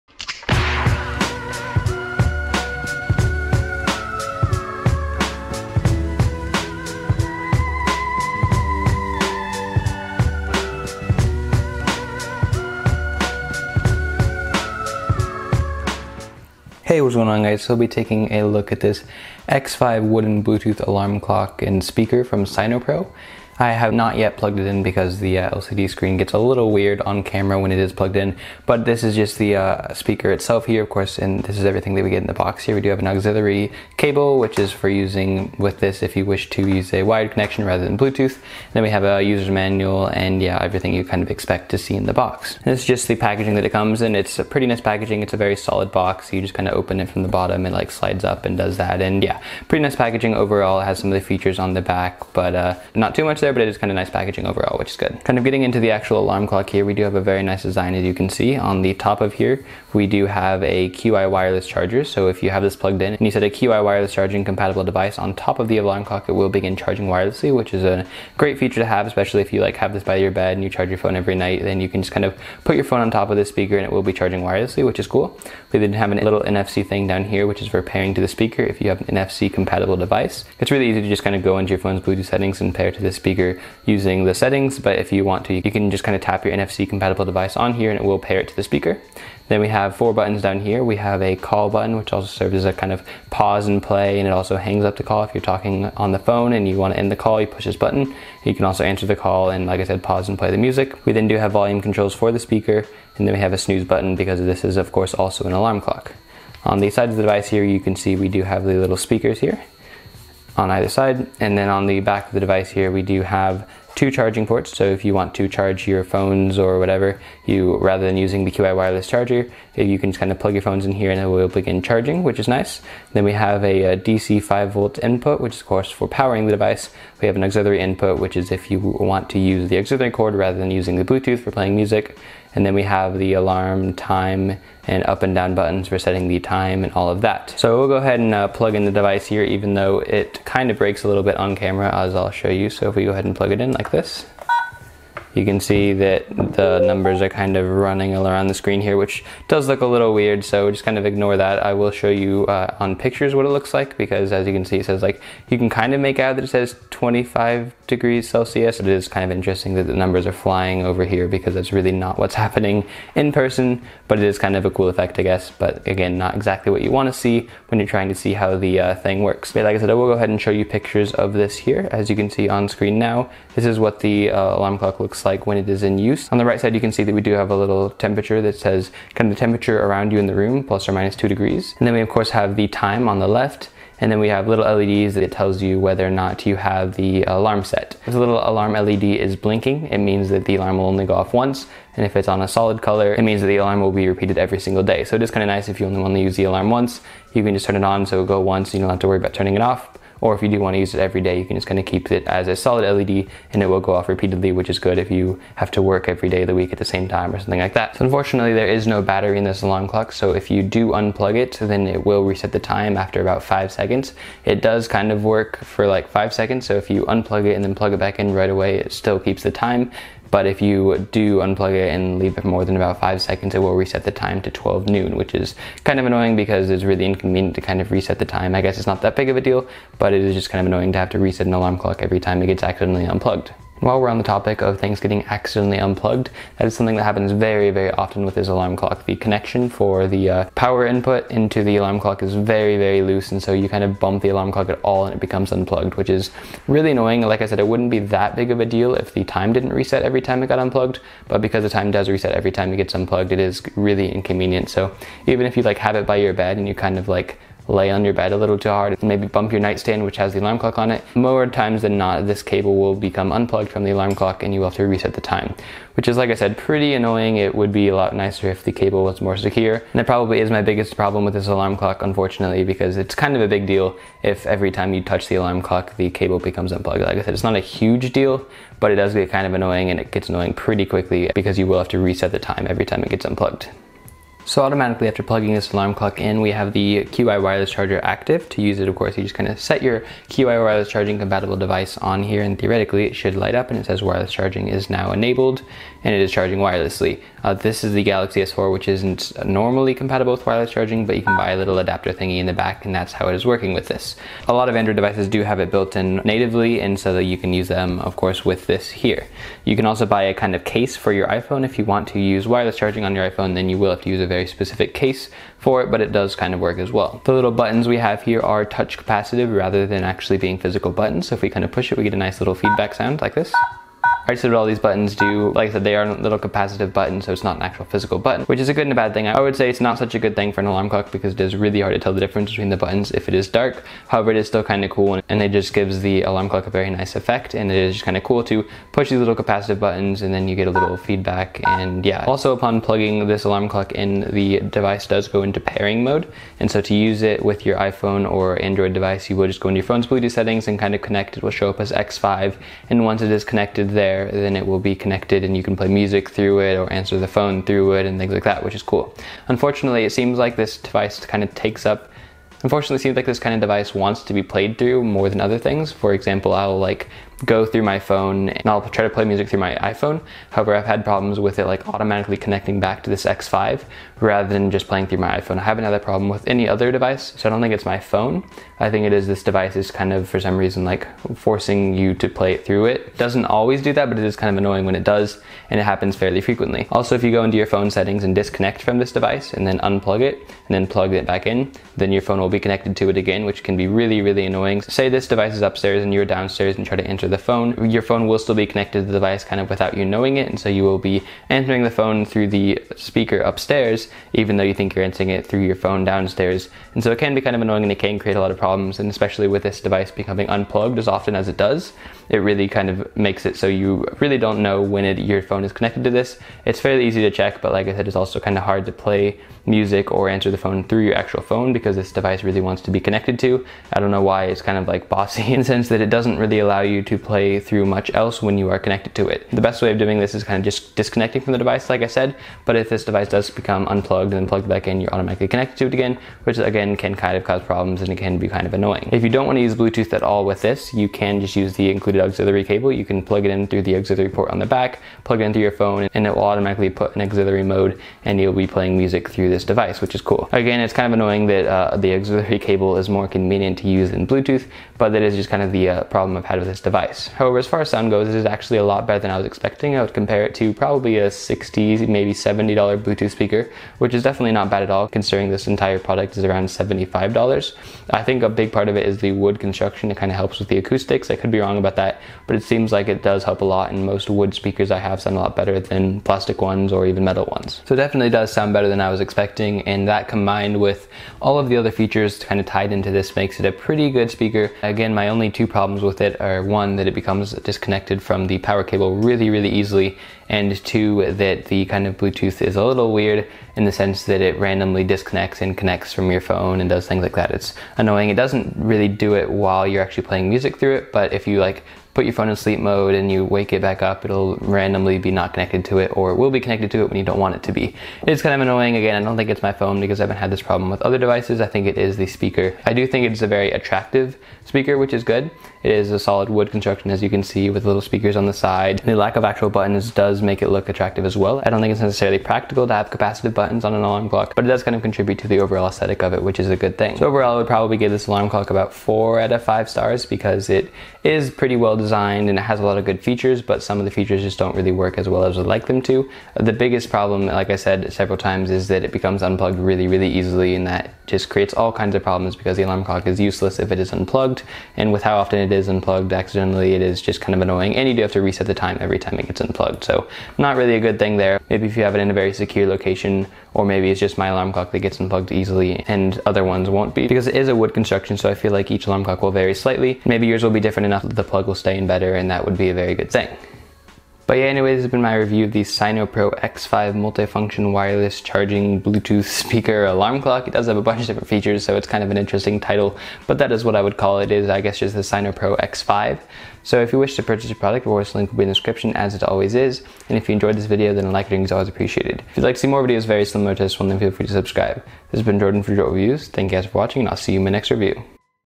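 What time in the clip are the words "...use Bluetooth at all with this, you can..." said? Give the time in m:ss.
7:19.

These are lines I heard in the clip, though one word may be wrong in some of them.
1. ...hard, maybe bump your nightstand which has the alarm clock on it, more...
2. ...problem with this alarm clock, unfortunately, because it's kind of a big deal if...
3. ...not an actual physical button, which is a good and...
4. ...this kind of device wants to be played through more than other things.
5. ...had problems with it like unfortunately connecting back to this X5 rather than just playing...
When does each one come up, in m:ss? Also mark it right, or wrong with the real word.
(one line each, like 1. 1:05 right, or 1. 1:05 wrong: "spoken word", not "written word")
1. 4:18 right
2. 4:30 right
3. 5:27 right
4. 6:03 right
5. 6:10 wrong: "automatically", not "unfortunately".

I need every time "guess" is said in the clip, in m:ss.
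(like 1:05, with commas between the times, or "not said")
2:45, 3:48, 9:34.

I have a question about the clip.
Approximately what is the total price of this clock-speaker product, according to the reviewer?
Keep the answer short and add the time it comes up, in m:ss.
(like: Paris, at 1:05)
$75, at 7:46.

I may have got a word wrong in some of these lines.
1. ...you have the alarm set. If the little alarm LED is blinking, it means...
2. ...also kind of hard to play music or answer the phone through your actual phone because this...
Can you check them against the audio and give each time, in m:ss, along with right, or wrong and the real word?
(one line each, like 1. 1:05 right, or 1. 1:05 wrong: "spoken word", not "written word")
1. 3:06 right
2. 6:58 right.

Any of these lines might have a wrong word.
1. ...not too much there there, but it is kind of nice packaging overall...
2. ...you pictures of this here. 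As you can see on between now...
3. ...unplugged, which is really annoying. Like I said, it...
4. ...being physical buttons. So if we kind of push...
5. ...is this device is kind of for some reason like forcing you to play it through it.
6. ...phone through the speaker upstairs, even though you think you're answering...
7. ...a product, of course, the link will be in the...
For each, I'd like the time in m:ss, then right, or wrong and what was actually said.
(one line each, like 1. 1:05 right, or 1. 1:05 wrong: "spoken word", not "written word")
1. 0:52 right
2. 2:50 wrong: "screen", not "between"
3. 4:05 right
4. 5:20 right
5. 6:19 right
6. 6:41 right
7. 9:37 right.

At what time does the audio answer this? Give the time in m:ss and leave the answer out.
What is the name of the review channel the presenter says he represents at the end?
9:45.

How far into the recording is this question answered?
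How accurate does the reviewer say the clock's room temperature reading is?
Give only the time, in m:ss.
3:00.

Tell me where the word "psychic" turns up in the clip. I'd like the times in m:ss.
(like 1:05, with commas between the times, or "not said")
not said.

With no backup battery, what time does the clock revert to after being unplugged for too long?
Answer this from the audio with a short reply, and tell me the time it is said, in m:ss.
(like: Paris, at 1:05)
12 noon, at 3:44.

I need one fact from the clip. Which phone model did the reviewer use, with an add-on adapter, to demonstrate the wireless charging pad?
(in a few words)
Galaxy S4.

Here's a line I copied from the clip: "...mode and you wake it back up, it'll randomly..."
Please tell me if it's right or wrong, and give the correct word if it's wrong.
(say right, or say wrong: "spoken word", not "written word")
right.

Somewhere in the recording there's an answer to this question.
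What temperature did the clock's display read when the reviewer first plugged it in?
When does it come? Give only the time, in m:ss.
2:36.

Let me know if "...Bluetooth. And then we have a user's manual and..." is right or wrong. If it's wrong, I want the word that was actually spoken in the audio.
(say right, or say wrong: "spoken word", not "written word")
right.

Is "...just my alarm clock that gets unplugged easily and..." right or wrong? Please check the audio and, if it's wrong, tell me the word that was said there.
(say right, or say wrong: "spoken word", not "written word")
right.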